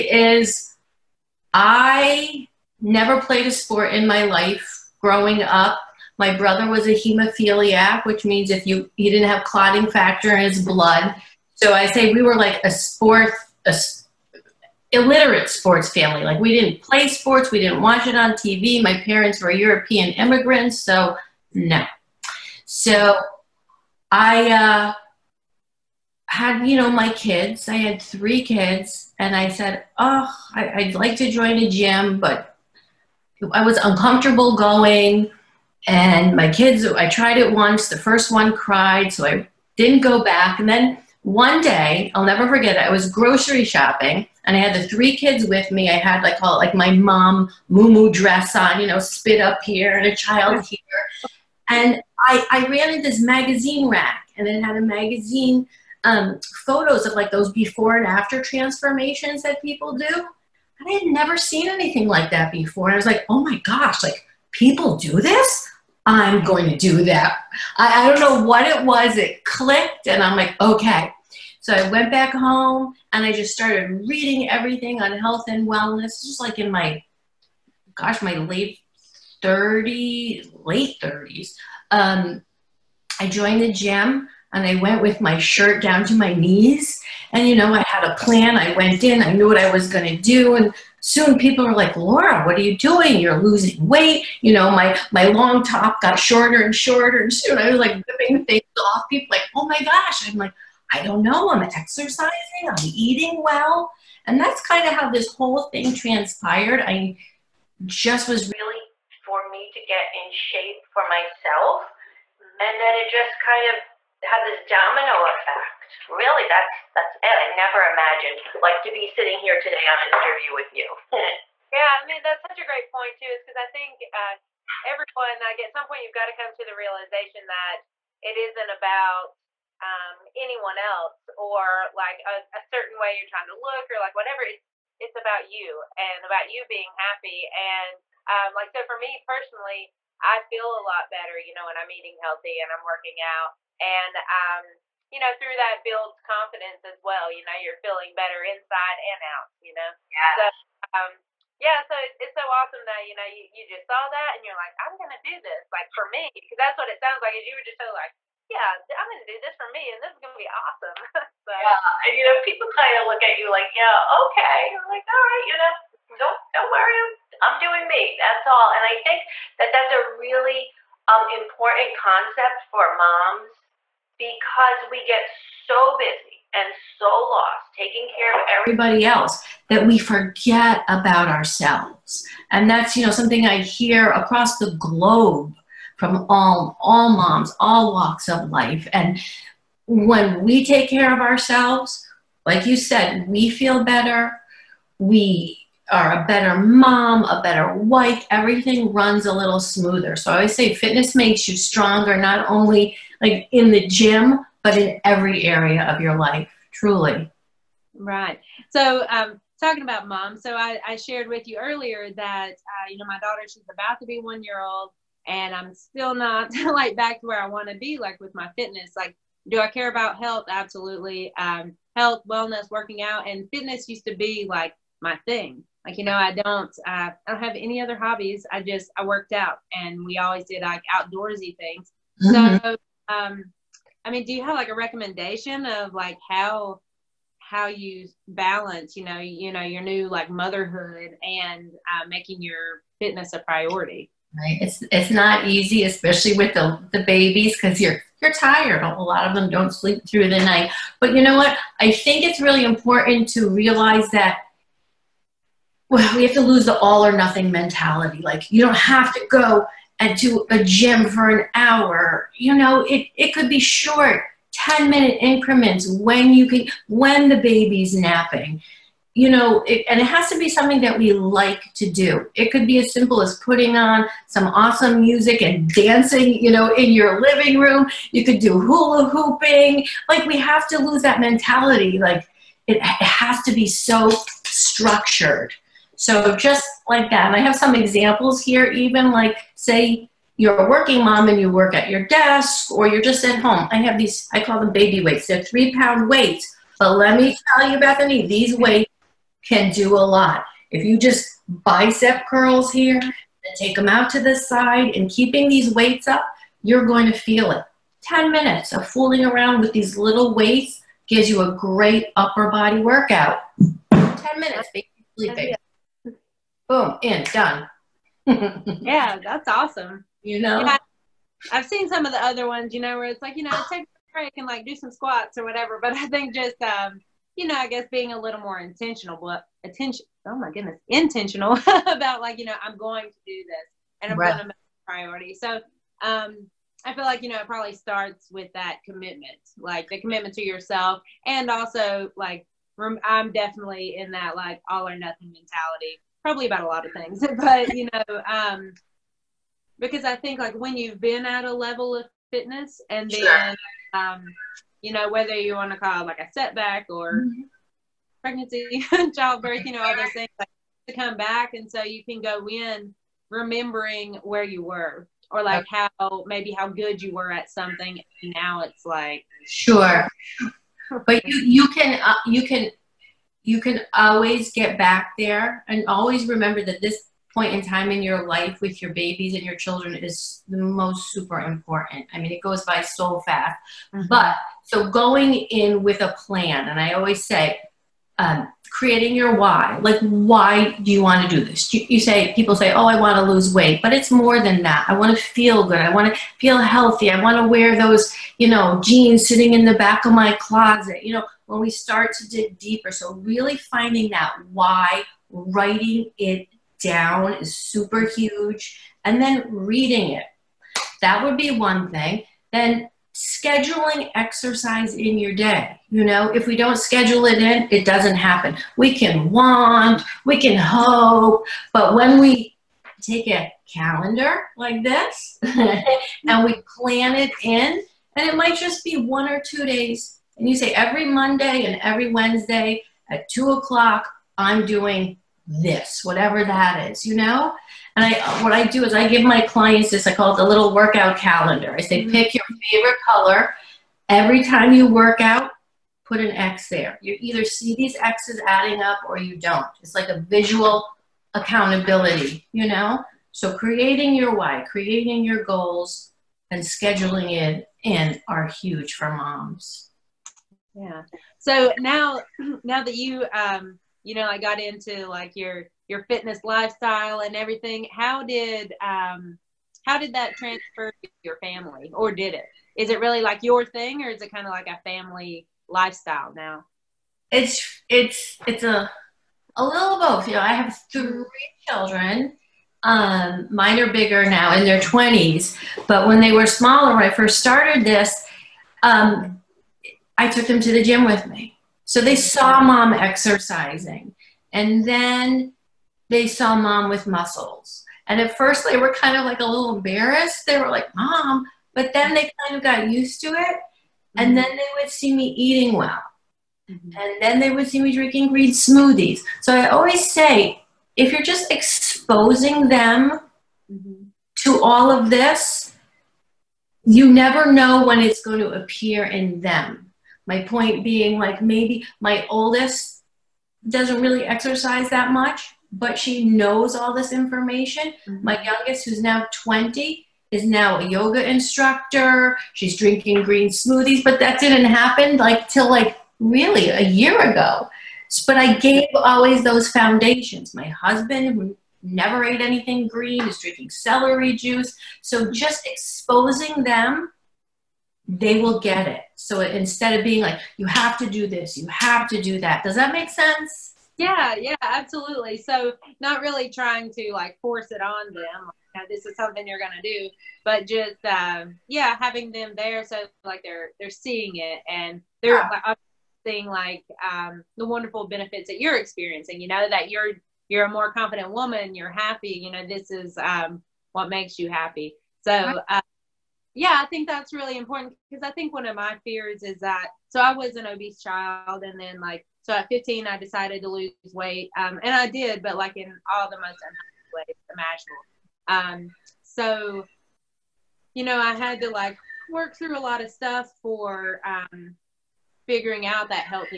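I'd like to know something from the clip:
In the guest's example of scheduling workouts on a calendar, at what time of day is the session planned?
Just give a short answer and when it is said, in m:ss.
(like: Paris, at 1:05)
2 o'clock, at 7:13.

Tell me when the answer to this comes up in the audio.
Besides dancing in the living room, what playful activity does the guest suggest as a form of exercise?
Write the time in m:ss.
4:38.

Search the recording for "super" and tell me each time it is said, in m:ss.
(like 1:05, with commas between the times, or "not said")
6:21, 6:47.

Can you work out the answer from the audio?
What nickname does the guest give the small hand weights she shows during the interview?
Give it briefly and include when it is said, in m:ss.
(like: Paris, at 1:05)
Baby weights, at 4:54.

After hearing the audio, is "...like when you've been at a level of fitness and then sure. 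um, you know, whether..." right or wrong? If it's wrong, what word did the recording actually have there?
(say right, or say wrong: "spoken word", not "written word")
right.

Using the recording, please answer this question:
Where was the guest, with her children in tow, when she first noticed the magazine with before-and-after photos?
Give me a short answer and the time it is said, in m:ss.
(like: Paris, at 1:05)
Grocery shopping, at 0:43.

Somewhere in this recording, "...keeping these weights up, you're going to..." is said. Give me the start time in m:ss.
5:05.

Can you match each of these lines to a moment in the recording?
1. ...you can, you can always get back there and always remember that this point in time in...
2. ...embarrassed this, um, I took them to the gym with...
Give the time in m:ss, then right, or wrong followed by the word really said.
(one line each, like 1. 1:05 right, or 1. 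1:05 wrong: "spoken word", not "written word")
1. 6:12 right
2. 8:07 wrong: "started", not "embarrassed".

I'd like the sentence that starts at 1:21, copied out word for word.
Um, I joined the gym and I went with my shirt down to my knees.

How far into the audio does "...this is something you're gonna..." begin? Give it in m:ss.
9:18.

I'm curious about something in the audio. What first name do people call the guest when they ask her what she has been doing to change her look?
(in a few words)
Laura.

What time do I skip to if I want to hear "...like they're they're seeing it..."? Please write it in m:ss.
9:23.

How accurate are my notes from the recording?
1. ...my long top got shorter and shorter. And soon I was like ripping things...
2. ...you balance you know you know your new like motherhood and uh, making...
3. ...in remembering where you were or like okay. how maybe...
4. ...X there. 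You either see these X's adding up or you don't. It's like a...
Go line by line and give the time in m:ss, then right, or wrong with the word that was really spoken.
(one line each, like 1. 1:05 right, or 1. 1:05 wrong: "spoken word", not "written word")
1. 1:35 right
2. 3:57 right
3. 6:02 right
4. 7:26 right.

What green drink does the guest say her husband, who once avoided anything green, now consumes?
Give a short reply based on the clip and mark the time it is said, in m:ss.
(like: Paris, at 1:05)
Celery juice, at 9:03.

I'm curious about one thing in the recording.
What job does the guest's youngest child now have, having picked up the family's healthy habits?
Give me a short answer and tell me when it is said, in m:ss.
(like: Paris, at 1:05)
Yoga instructor, at 8:50.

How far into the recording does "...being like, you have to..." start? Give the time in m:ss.
9:10.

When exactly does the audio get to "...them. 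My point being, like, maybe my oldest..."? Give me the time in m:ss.
8:39.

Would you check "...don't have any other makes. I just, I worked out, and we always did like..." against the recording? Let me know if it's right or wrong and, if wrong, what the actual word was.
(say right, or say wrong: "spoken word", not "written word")
wrong: "hobbies", not "makes".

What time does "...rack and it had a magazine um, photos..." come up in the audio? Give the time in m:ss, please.
0:53.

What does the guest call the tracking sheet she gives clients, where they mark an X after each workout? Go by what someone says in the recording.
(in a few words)
Little workout calendar.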